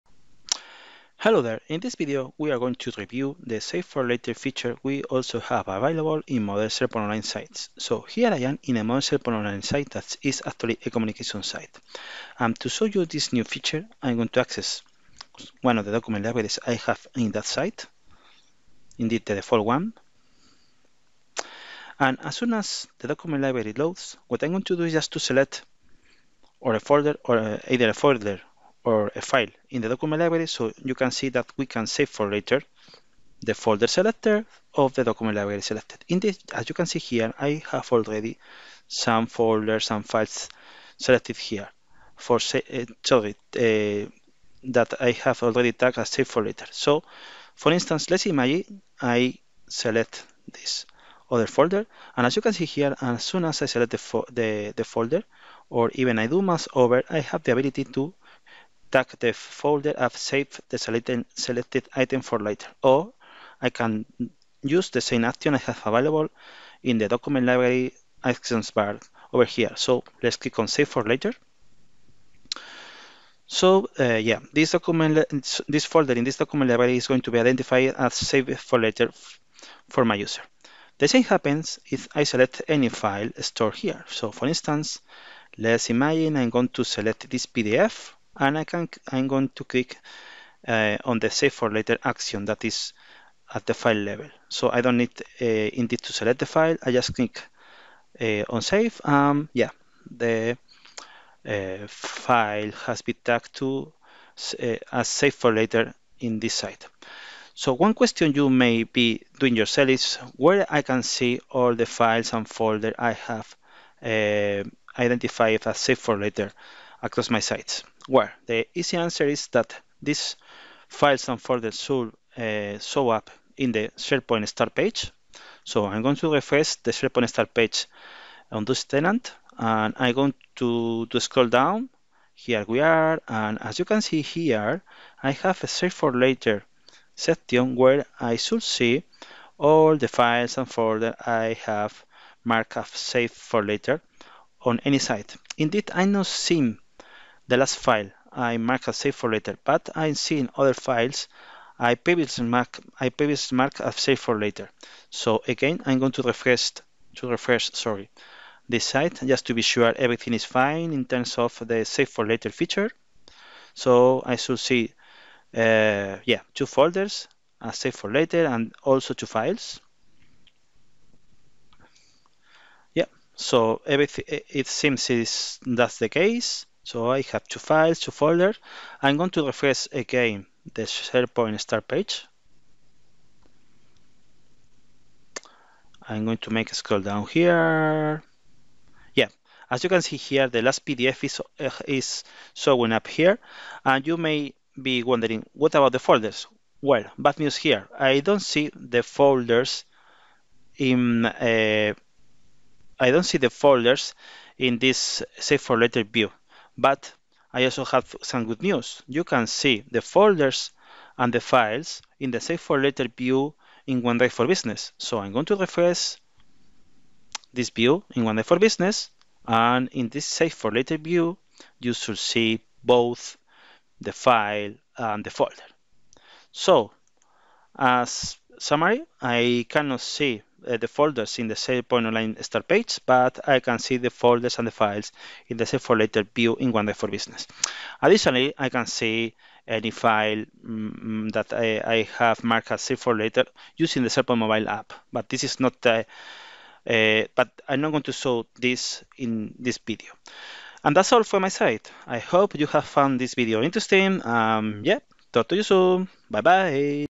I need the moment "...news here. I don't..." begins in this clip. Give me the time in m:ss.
3:17.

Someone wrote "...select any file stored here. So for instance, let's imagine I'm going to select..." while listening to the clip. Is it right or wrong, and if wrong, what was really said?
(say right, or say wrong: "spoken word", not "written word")
right.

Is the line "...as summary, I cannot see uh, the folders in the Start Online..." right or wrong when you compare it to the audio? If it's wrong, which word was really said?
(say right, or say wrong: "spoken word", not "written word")
wrong: "SharePoint", not "Start".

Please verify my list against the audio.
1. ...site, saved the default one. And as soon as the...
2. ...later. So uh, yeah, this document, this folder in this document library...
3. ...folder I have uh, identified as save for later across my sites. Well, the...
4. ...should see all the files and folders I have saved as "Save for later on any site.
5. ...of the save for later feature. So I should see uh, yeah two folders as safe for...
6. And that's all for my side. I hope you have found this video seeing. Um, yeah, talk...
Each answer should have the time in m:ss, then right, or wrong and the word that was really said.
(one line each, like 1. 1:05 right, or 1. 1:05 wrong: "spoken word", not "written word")
1. 0:17 wrong: "indeed", not "saved"
2. 1:11 right
3. 1:52 right
4. 2:18 wrong: "marked", not "saved"
5. 2:41 right
6. 4:10 wrong: "interesting", not "seeing".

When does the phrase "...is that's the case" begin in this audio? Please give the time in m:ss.
2:55.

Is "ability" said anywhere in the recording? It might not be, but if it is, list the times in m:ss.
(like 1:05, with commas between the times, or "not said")
0:57.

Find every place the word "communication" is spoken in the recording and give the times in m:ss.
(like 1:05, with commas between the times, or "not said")
0:10.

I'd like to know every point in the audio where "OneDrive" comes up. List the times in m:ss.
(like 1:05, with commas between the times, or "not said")
3:34, 3:38, 3:56.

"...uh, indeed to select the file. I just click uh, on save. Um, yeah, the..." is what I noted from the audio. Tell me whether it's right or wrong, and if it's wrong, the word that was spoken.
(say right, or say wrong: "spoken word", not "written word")
right.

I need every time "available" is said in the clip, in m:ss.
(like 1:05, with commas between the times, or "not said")
0:05, 1:05.